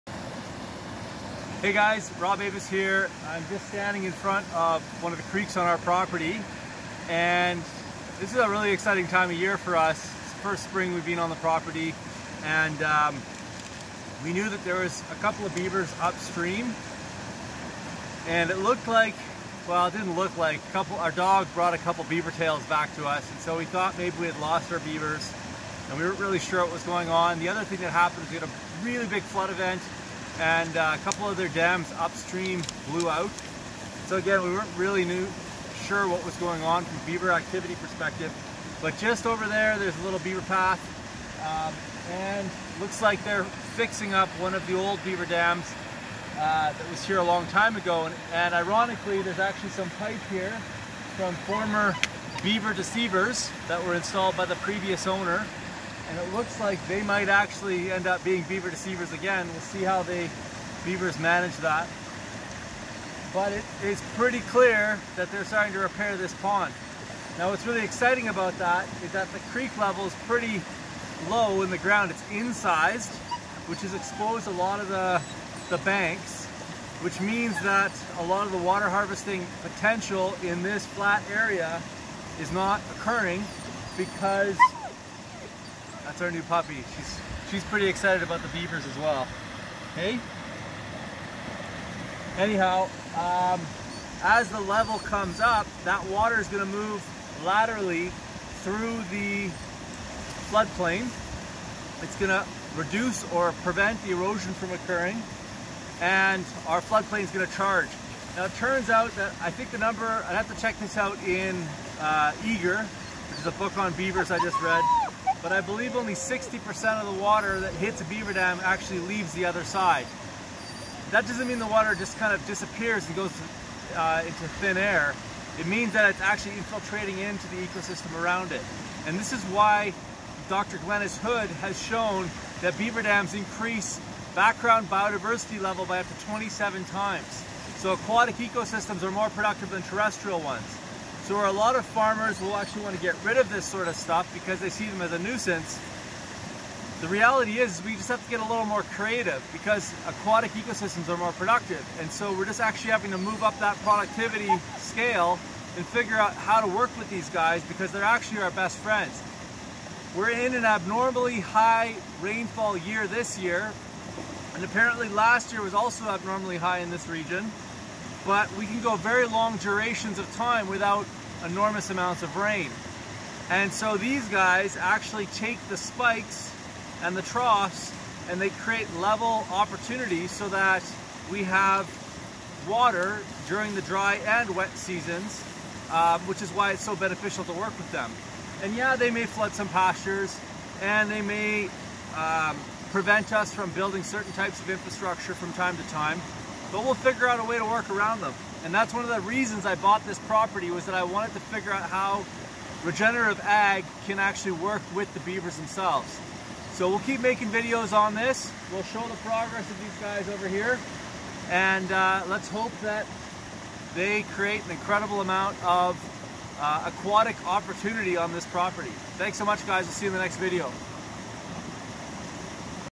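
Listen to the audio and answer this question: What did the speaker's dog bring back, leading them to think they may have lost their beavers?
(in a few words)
Beaver tails.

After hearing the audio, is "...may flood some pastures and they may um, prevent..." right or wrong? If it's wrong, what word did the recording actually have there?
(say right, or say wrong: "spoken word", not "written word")
right.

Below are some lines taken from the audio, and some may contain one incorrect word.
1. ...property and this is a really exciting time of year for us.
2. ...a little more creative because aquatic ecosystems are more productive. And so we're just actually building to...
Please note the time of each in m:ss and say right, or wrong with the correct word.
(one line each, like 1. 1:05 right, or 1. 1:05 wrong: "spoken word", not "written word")
1. 0:05 right
2. 2:28 wrong: "having", not "building".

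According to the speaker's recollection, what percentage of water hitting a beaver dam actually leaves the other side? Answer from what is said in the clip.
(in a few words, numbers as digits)
60%.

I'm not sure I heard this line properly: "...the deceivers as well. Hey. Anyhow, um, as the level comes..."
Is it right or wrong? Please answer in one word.
wrong.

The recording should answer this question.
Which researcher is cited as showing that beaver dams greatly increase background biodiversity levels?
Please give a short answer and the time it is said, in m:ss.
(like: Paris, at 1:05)
Dr. Glynnis Hood, at 2:10.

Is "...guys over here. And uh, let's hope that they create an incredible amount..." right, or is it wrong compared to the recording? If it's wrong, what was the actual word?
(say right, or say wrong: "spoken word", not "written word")
right.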